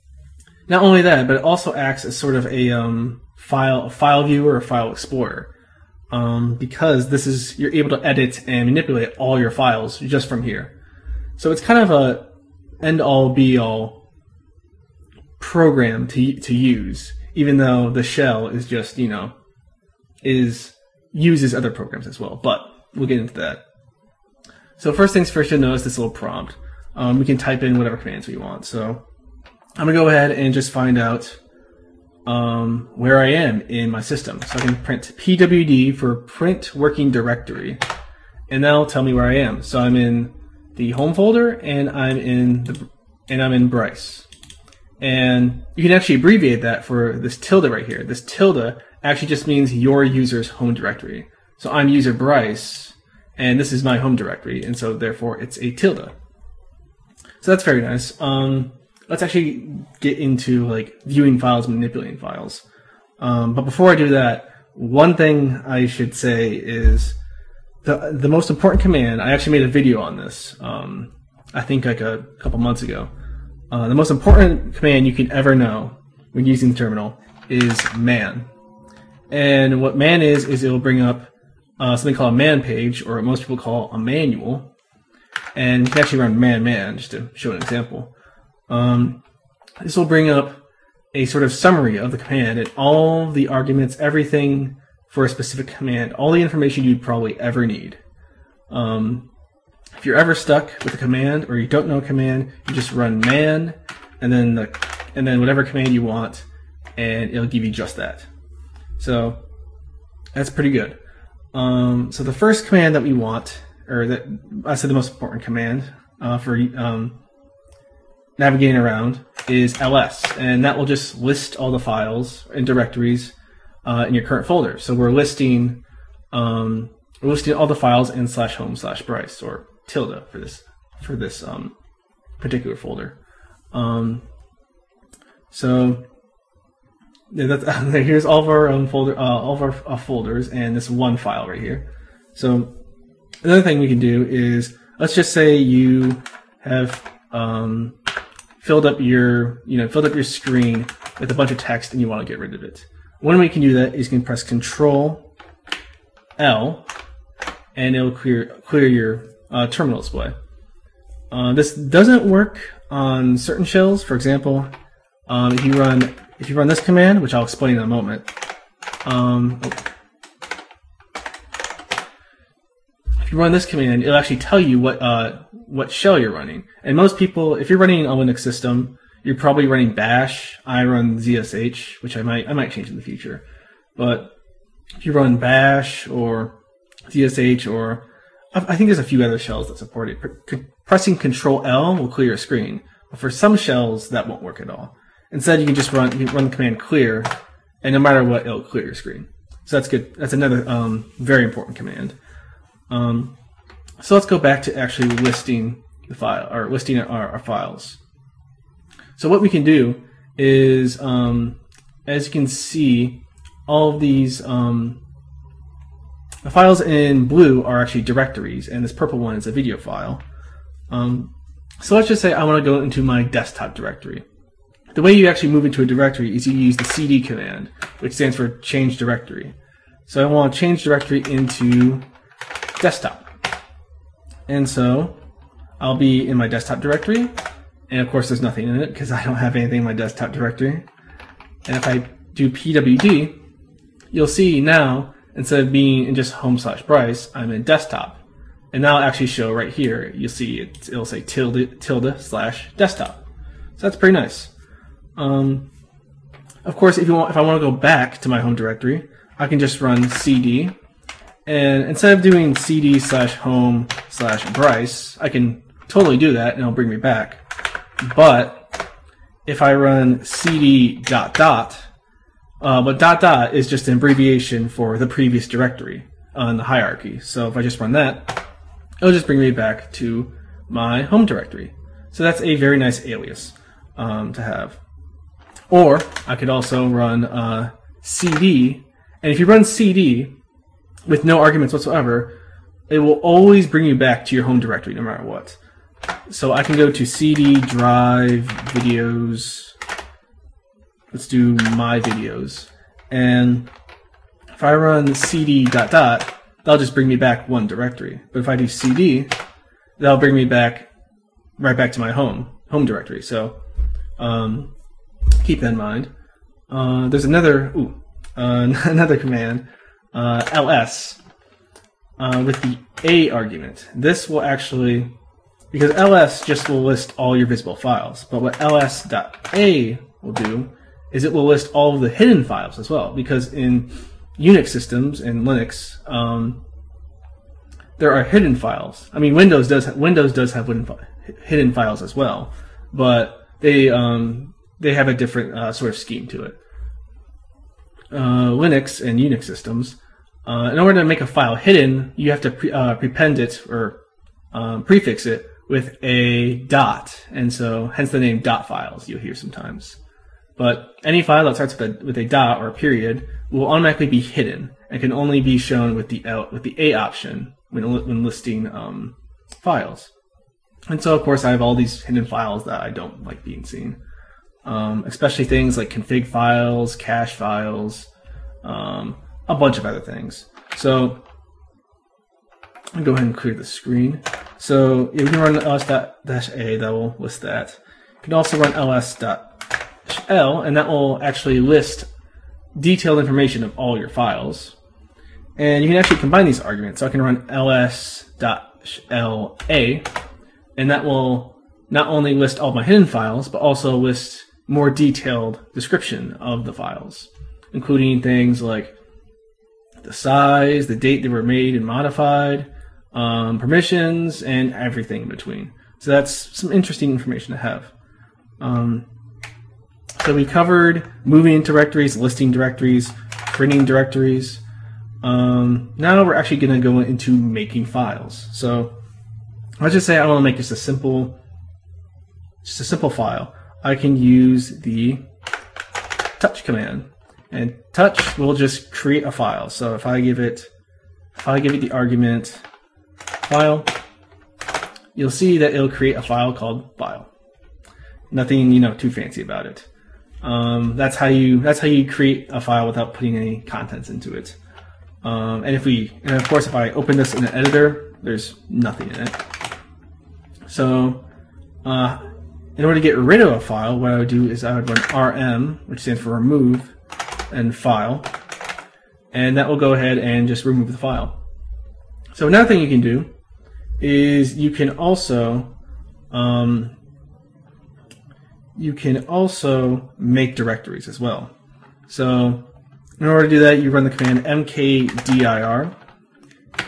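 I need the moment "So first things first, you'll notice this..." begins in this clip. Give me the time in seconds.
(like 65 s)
24 s.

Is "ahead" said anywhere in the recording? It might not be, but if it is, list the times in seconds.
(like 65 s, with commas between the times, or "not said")
30 s, 383 s, 469 s.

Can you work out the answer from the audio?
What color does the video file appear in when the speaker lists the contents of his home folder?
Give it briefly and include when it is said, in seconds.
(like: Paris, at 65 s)
purple, at 218 s.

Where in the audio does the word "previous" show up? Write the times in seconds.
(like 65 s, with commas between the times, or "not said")
275 s.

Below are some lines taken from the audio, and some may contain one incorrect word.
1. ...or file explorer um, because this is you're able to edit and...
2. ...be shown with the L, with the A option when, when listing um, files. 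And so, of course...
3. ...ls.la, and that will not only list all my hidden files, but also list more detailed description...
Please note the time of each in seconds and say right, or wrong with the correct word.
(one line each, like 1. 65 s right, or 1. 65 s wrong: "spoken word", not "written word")
1. 4 s right
2. 365 s right
3. 397 s right.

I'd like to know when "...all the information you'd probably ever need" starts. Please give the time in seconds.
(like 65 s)
96 s.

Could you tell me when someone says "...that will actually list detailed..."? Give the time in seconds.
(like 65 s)
390 s.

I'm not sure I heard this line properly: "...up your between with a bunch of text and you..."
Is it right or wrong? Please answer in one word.
wrong.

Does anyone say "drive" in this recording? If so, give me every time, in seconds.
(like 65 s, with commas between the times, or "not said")
297 s.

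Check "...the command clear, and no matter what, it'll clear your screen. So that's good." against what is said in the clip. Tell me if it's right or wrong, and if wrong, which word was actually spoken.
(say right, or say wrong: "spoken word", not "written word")
right.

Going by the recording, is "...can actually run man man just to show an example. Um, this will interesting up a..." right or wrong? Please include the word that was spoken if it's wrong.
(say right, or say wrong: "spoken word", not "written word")
wrong: "bring", not "interesting".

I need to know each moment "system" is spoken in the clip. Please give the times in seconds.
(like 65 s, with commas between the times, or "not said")
34 s, 178 s, 334 s, 349 s.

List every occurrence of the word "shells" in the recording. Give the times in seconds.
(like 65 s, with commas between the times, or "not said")
18 s, 163 s, 175 s, 189 s, 193 s.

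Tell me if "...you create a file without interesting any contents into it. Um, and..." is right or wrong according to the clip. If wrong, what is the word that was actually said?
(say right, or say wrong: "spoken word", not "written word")
wrong: "putting", not "interesting".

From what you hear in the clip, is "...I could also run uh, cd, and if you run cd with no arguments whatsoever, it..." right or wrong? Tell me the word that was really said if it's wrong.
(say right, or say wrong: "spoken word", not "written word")
right.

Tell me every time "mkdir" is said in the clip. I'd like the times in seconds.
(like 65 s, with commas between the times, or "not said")
484 s.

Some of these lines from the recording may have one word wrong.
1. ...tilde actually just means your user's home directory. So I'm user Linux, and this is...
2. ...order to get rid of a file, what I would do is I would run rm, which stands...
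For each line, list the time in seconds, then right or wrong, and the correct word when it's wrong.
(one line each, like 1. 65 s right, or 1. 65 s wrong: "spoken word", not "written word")
1. 48 s wrong: "Bryce", not "Linux"
2. 462 s right.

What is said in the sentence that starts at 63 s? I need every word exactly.
Um, but before I do that, one thing I should say is the the most important command.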